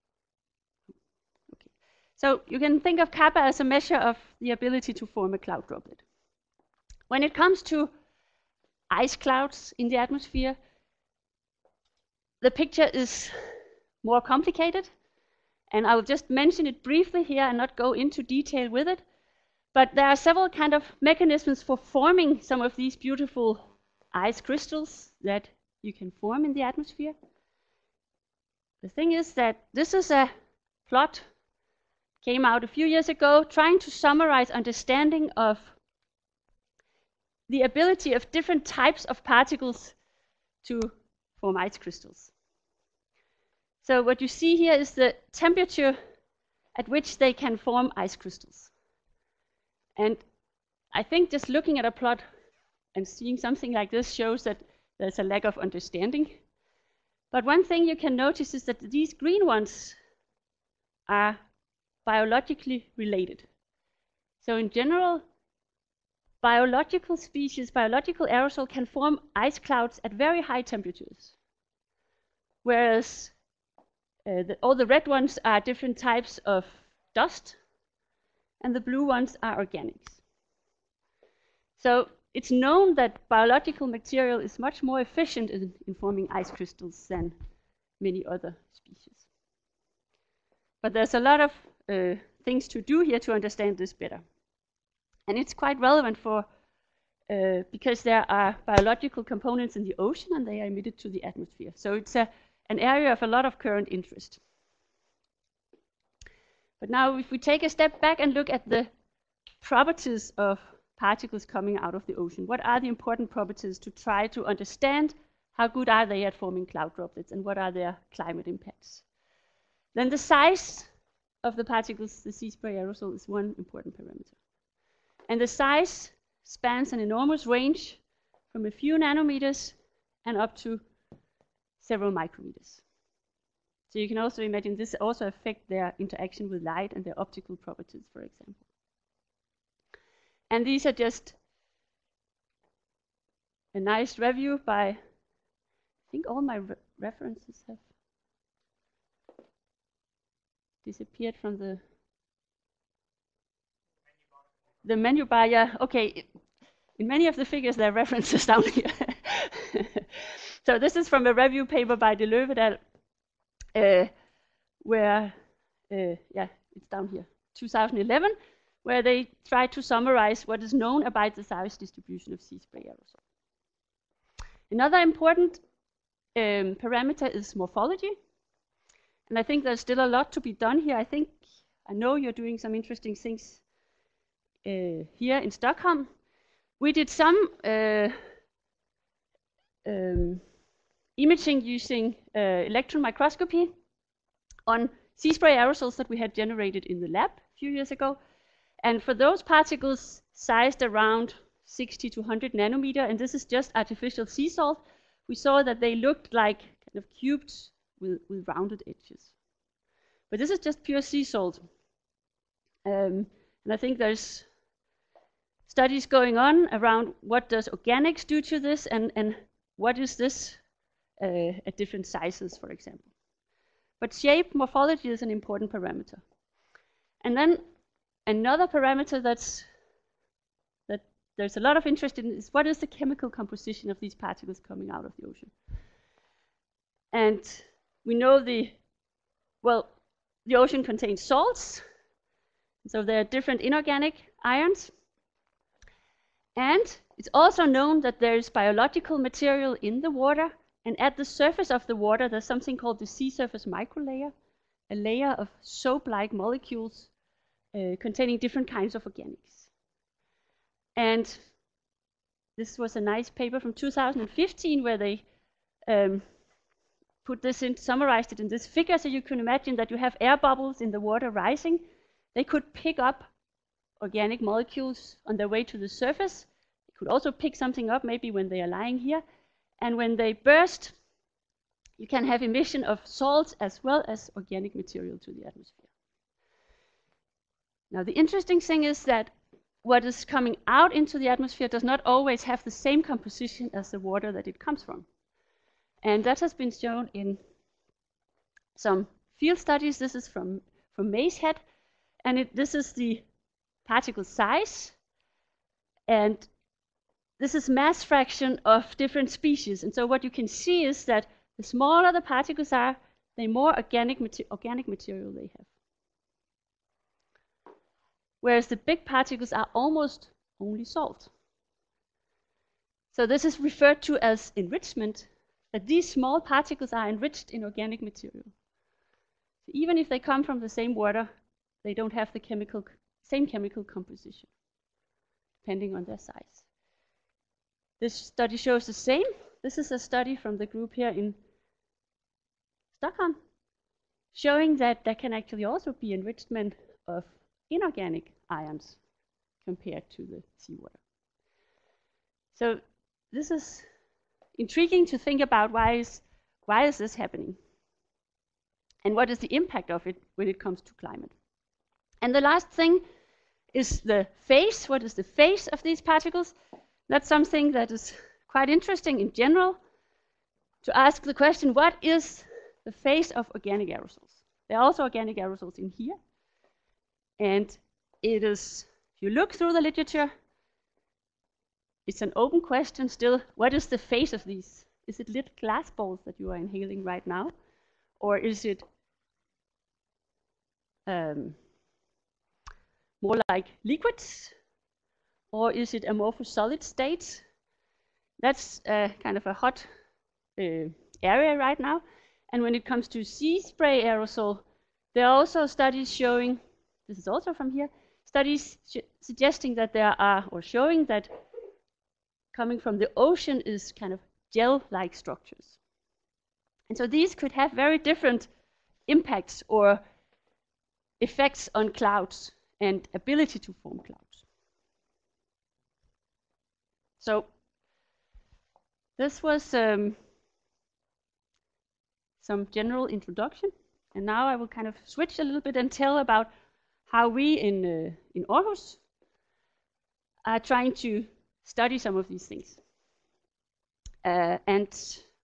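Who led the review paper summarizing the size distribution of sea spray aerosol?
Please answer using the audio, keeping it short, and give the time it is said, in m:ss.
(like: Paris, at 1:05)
De Leeuw et al, at 2:42.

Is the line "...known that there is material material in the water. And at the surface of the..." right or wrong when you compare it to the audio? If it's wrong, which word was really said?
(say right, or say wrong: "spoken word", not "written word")
wrong: "biological", not "material".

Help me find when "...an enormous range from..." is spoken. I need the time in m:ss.
2:06.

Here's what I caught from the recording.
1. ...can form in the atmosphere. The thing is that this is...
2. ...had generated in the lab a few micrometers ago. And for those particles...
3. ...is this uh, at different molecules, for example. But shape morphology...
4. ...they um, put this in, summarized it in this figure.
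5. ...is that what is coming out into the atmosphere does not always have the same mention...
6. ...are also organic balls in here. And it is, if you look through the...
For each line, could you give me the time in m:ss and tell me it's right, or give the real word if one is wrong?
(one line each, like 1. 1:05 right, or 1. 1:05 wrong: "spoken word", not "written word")
1. 0:25 right
2. 3:16 wrong: "years", not "micrometers"
3. 3:39 wrong: "sizes", not "molecules"
4. 4:24 right
5. 4:48 wrong: "composition", not "mention"
6. 6:14 wrong: "aerosols", not "balls".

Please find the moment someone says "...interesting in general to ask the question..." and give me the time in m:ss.
6:08.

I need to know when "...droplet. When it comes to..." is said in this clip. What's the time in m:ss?
0:05.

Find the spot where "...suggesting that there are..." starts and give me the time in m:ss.
6:49.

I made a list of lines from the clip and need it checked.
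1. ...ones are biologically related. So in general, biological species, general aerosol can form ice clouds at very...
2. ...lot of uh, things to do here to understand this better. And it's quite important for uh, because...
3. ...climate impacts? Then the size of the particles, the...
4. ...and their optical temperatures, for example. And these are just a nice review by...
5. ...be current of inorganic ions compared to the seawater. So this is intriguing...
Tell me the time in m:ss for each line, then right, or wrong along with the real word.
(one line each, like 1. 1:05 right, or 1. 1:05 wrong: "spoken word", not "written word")
1. 0:59 wrong: "biological", not "general"
2. 1:31 wrong: "relevant", not "important"
3. 1:58 right
4. 2:16 wrong: "properties", not "temperatures"
5. 5:45 wrong: "enrichment", not "current".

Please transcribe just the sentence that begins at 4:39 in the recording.
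And when they burst, you can have emission of salts as well as organic material to the atmosphere.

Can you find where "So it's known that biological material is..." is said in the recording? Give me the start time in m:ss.
1:21.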